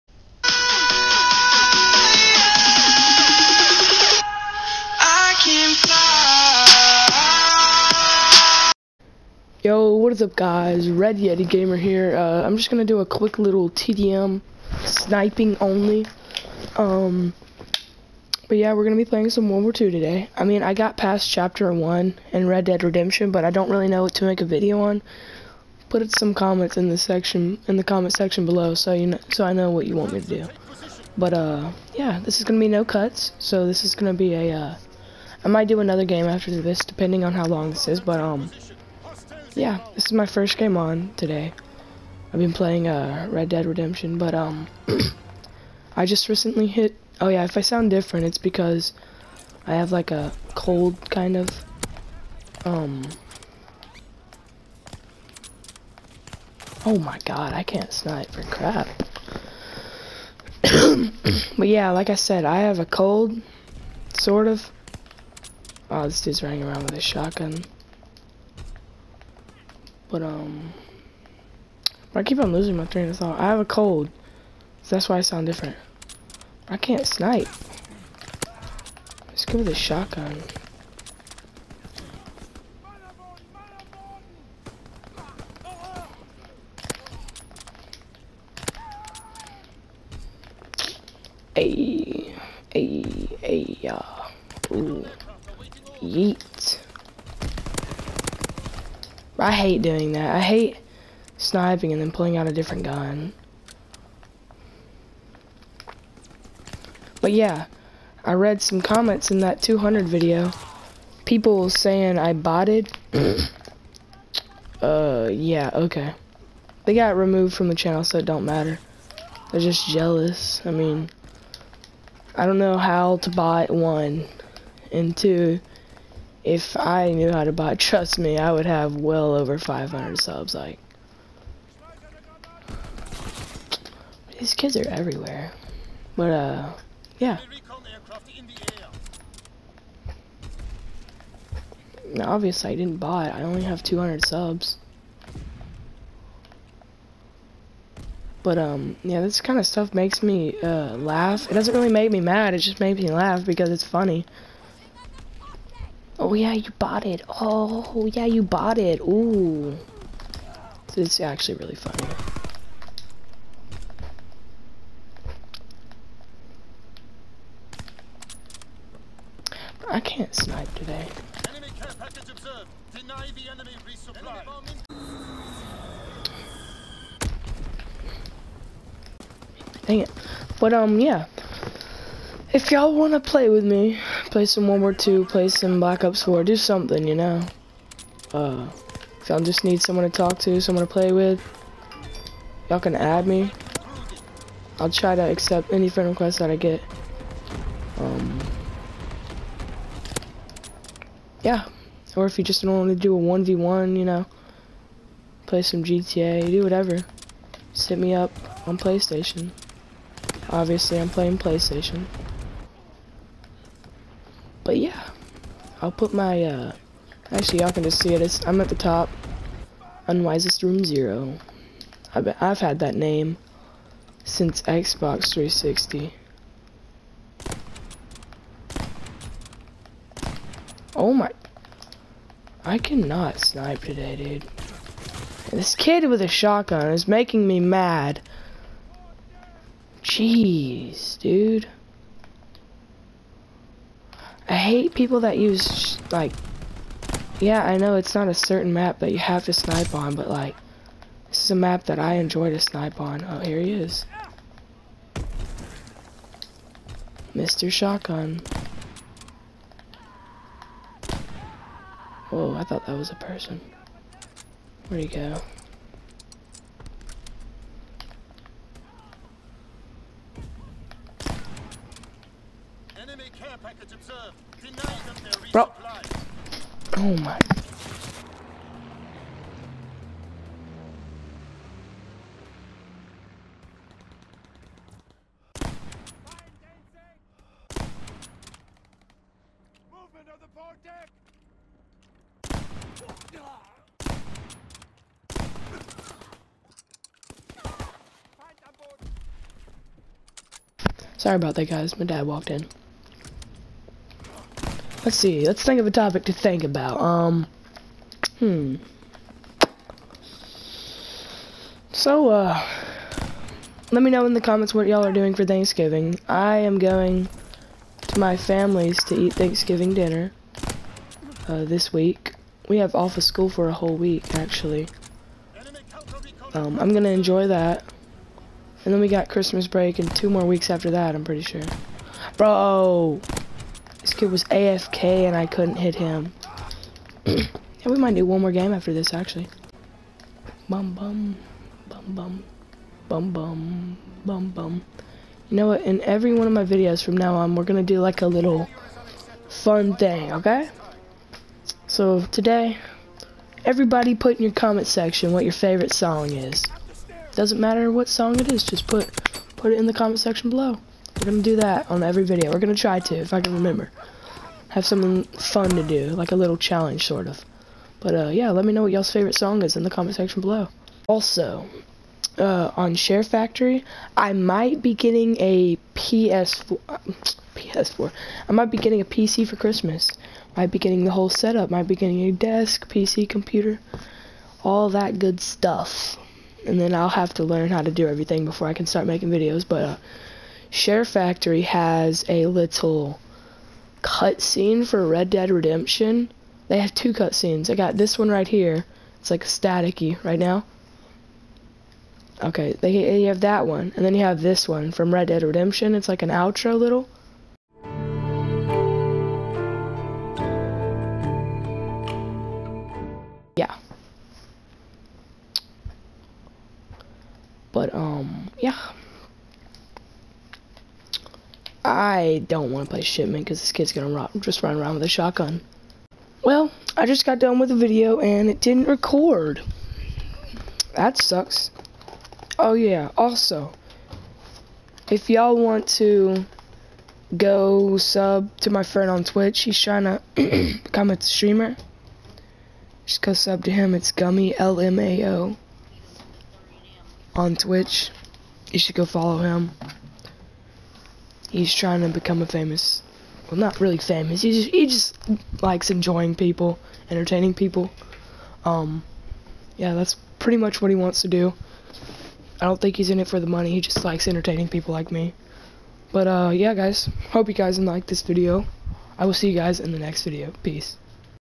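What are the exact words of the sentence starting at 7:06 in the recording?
Well, I just got done with the video and it didn't record.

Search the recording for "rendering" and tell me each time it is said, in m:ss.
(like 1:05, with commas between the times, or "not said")
not said.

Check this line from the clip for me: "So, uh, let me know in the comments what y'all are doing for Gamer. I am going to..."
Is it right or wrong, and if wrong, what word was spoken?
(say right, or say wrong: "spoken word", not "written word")
wrong: "Thanksgiving", not "Gamer".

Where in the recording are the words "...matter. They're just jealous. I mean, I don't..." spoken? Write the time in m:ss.
1:58.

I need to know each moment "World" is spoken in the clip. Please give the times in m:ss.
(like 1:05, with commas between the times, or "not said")
0:19, 3:04.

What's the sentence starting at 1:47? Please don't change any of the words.
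But yeah, I read some comments in that 200 video.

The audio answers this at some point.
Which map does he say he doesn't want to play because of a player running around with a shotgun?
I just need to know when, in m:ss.
7:03.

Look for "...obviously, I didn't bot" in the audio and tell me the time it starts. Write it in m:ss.
2:22.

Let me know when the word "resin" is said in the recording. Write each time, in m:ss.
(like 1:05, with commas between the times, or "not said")
not said.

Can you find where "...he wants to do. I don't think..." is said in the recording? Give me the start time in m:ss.
7:40.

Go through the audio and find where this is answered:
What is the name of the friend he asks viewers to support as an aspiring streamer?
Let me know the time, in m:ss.
7:24.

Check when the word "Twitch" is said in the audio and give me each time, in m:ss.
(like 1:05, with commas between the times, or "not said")
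7:19, 7:27.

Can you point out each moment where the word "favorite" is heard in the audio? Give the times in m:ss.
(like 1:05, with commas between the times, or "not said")
5:55, 6:09.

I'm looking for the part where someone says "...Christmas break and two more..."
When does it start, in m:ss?
5:29.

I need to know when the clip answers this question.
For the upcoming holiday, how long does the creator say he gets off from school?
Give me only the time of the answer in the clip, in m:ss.
5:23.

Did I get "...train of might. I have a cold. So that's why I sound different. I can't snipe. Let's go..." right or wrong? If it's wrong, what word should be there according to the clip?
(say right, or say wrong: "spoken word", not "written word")
wrong: "thought", not "might".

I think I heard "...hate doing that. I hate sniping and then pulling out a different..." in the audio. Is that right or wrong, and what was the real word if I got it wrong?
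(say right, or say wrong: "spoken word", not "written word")
right.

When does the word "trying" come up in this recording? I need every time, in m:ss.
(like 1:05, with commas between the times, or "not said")
7:19, 7:31.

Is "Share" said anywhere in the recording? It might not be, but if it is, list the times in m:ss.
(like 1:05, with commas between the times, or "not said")
6:12, 6:30.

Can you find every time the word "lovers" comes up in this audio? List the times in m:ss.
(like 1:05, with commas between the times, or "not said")
not said.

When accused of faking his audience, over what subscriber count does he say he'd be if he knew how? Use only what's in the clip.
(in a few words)
500.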